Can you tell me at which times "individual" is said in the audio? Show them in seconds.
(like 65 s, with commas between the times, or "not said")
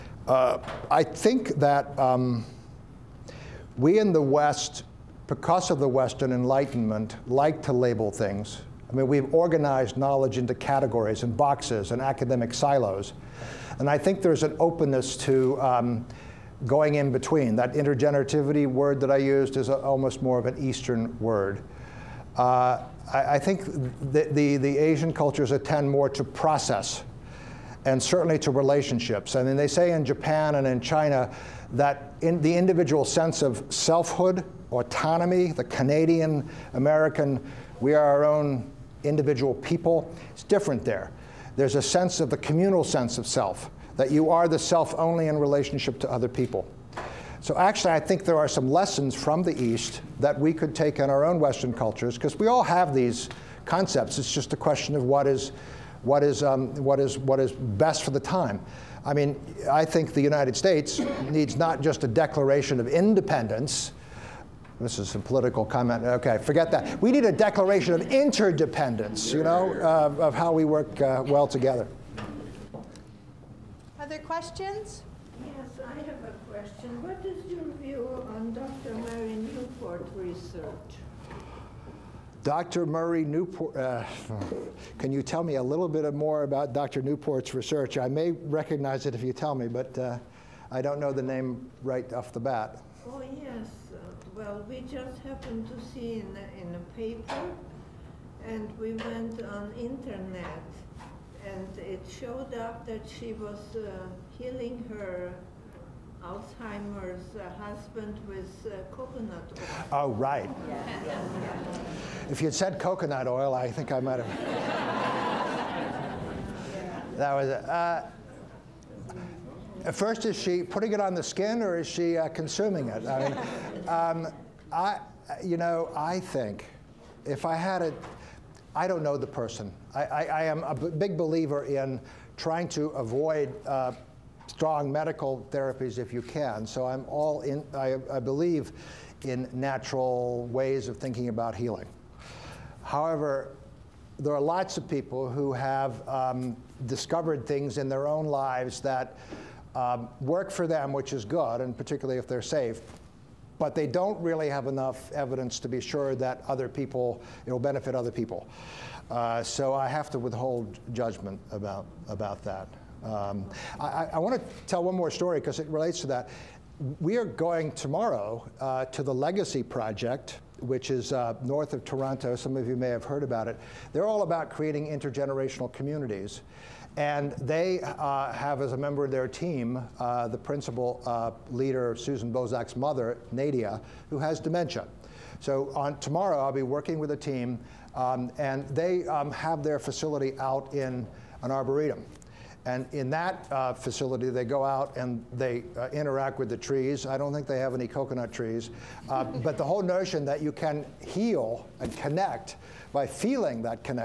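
32 s, 39 s.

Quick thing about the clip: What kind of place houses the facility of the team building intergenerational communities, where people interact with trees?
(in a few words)
an arboretum.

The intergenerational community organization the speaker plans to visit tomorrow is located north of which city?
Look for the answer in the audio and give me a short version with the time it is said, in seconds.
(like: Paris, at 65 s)
Toronto, at 171 s.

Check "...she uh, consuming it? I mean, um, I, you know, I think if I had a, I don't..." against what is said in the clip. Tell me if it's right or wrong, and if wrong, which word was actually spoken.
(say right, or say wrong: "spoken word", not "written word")
right.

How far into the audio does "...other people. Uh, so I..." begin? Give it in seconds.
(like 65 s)
157 s.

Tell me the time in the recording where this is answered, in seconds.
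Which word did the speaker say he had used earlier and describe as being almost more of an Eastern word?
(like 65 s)
17 s.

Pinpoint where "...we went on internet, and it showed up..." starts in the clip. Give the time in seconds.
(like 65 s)
98 s.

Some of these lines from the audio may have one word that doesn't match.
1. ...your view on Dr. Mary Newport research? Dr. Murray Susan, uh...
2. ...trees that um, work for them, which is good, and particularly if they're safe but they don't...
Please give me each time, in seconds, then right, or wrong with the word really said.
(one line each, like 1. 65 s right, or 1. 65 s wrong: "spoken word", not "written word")
1. 77 s wrong: "Newport", not "Susan"
2. 148 s wrong: "lives", not "trees".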